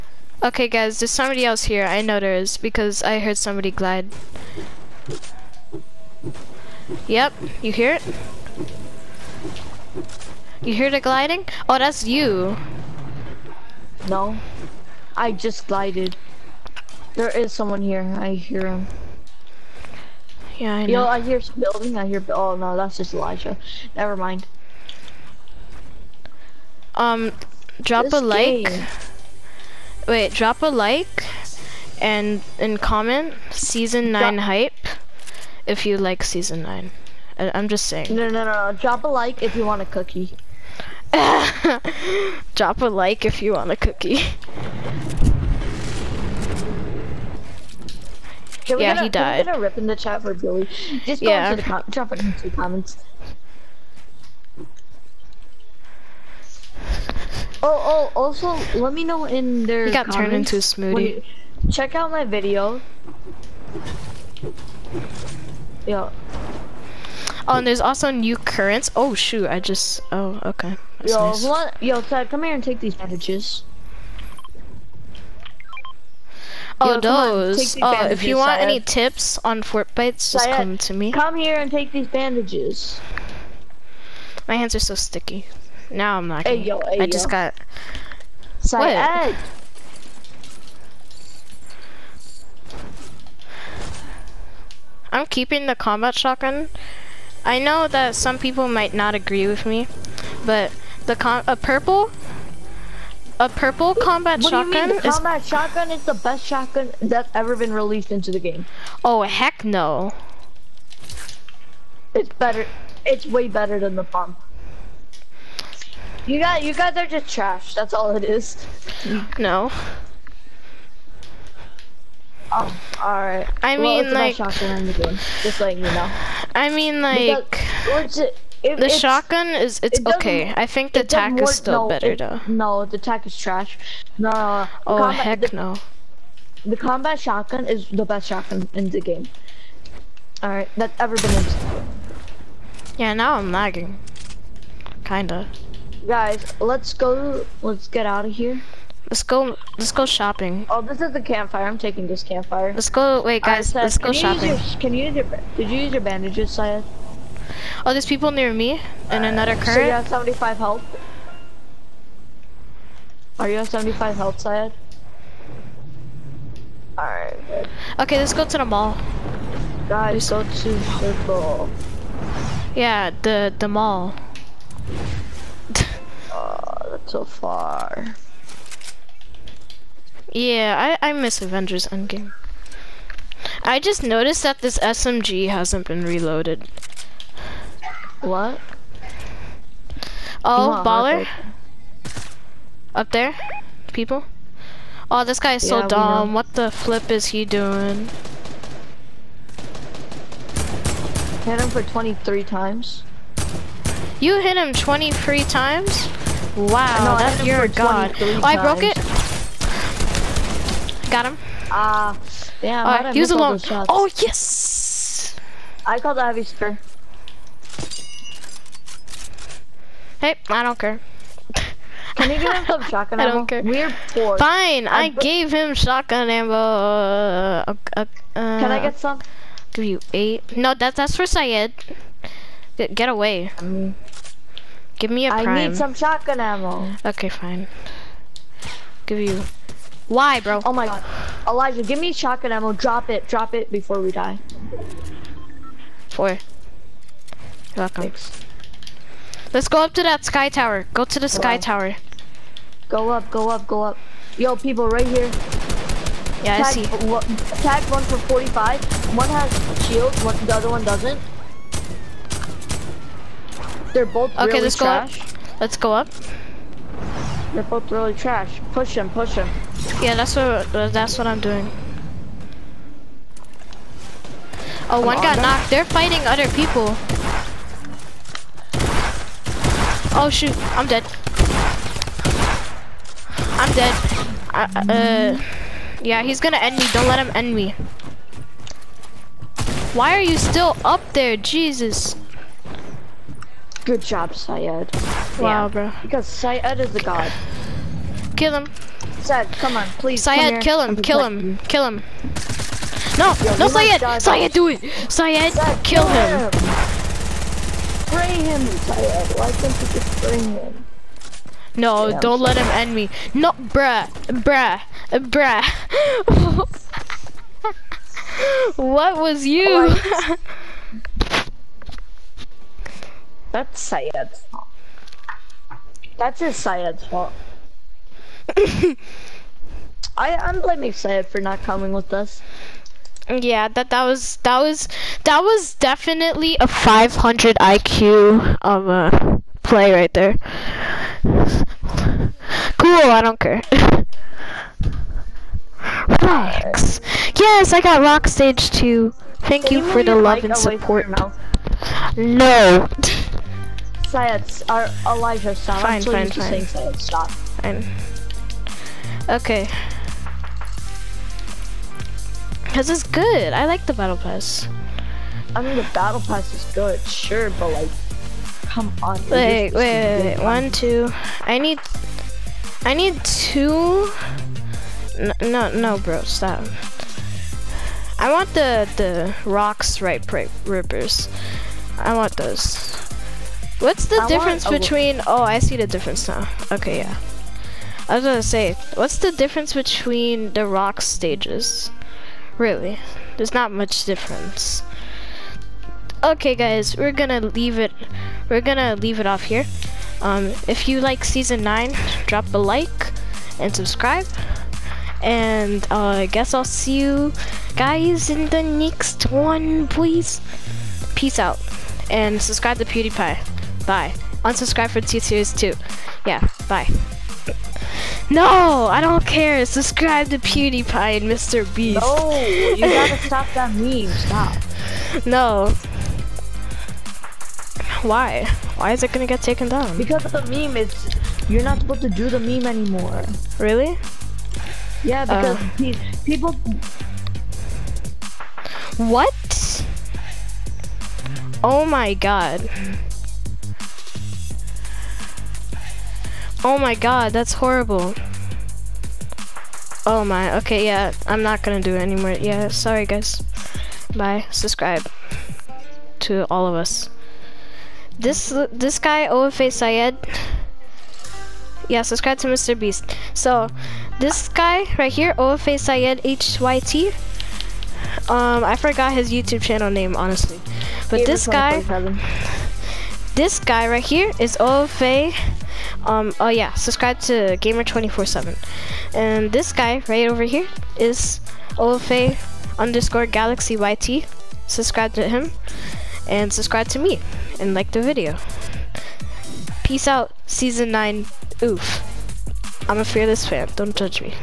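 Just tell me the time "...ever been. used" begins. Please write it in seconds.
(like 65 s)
140 s.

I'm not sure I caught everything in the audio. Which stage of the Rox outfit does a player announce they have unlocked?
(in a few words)
Stage two.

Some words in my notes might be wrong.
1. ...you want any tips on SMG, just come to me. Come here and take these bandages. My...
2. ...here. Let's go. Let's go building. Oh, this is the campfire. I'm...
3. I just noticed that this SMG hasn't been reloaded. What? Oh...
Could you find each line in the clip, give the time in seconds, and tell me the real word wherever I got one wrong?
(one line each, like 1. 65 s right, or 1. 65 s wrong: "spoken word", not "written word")
1. 78 s wrong: "Fortbytes", not "SMG"
2. 148 s wrong: "shopping", not "building"
3. 183 s right.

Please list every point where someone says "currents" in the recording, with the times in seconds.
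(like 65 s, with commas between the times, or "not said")
68 s, 159 s.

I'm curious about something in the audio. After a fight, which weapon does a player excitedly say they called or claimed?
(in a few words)
Heavy spear.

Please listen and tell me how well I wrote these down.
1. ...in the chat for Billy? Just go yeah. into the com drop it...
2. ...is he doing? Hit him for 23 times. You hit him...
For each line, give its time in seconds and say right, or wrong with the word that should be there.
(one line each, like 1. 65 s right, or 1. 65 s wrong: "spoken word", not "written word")
1. 49 s right
2. 197 s right.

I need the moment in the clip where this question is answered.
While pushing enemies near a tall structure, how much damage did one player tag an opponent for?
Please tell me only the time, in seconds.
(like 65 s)
258 s.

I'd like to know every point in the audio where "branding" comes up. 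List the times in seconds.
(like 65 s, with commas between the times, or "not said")
not said.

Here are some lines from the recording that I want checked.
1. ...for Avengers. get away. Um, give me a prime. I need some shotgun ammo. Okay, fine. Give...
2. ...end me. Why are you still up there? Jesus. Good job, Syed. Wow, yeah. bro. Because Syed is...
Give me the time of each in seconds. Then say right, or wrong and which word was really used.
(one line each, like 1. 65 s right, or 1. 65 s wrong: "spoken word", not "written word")
1. 231 s wrong: "Syed", not "Avengers"
2. 287 s right.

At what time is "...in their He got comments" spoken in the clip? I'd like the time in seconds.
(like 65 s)
59 s.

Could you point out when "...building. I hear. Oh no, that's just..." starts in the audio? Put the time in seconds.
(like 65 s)
21 s.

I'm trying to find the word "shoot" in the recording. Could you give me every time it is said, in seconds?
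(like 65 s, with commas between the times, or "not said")
69 s, 280 s.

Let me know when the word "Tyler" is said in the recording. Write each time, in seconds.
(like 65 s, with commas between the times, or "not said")
308 s.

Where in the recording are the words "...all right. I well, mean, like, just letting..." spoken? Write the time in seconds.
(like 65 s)
123 s.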